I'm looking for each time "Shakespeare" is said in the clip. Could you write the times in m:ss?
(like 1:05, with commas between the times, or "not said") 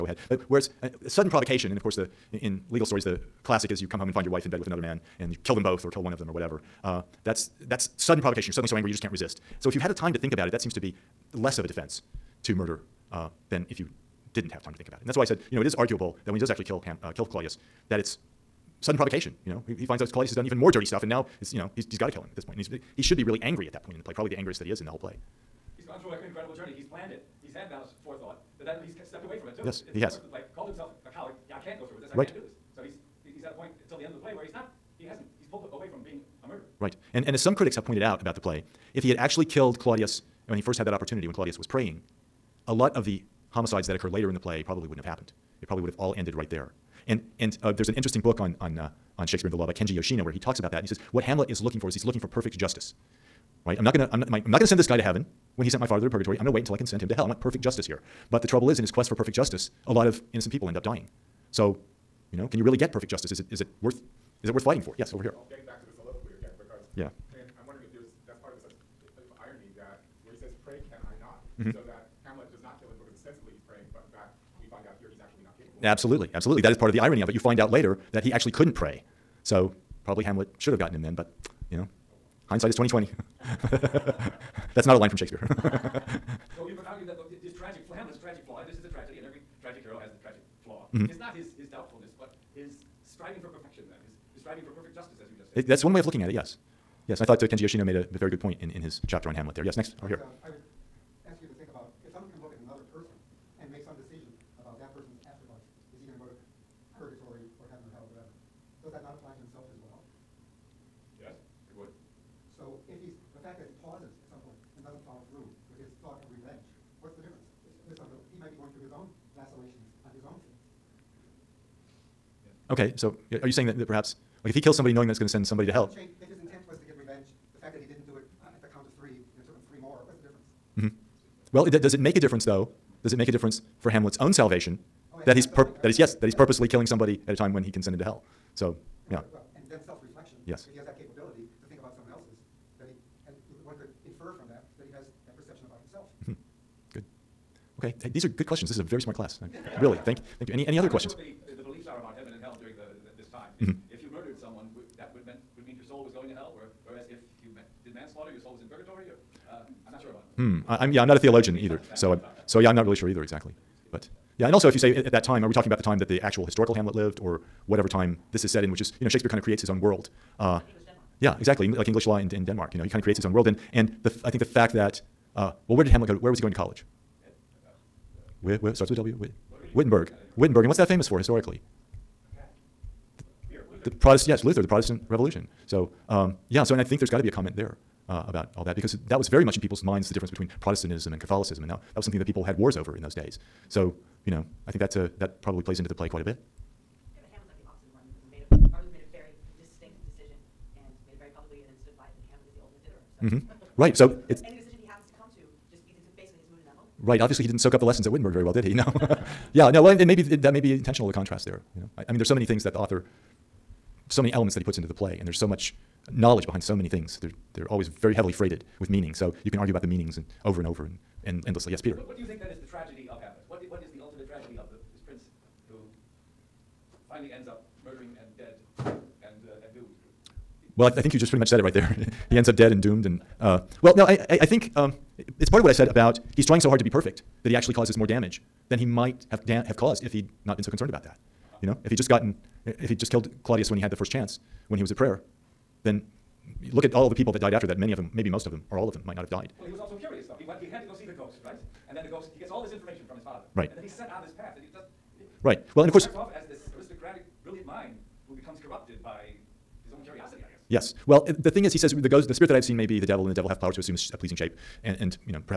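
0:49, 1:25, 2:49.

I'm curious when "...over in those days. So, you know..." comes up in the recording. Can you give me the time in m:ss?
3:12.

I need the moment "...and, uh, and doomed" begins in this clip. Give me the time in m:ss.
3:48.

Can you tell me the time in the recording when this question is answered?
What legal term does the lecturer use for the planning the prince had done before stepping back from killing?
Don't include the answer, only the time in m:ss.
0:27.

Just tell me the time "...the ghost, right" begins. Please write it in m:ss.
4:11.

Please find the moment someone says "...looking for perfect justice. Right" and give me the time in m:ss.
0:52.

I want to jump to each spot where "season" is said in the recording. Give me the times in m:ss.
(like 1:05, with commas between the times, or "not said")
not said.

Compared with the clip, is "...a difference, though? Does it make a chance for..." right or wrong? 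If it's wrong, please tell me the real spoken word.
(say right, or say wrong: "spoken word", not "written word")
wrong: "difference", not "chance".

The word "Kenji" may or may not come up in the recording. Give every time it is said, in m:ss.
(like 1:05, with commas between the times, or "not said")
0:49, 1:37.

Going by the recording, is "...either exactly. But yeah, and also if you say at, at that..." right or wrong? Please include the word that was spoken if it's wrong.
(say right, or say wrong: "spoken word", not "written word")
right.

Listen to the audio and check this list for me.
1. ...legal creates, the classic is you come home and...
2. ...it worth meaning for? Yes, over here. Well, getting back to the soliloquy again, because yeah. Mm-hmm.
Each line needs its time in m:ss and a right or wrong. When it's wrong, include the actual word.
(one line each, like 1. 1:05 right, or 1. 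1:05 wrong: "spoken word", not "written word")
1. 0:02 wrong: "stories", not "creates"
2. 1:04 wrong: "fighting", not "meaning".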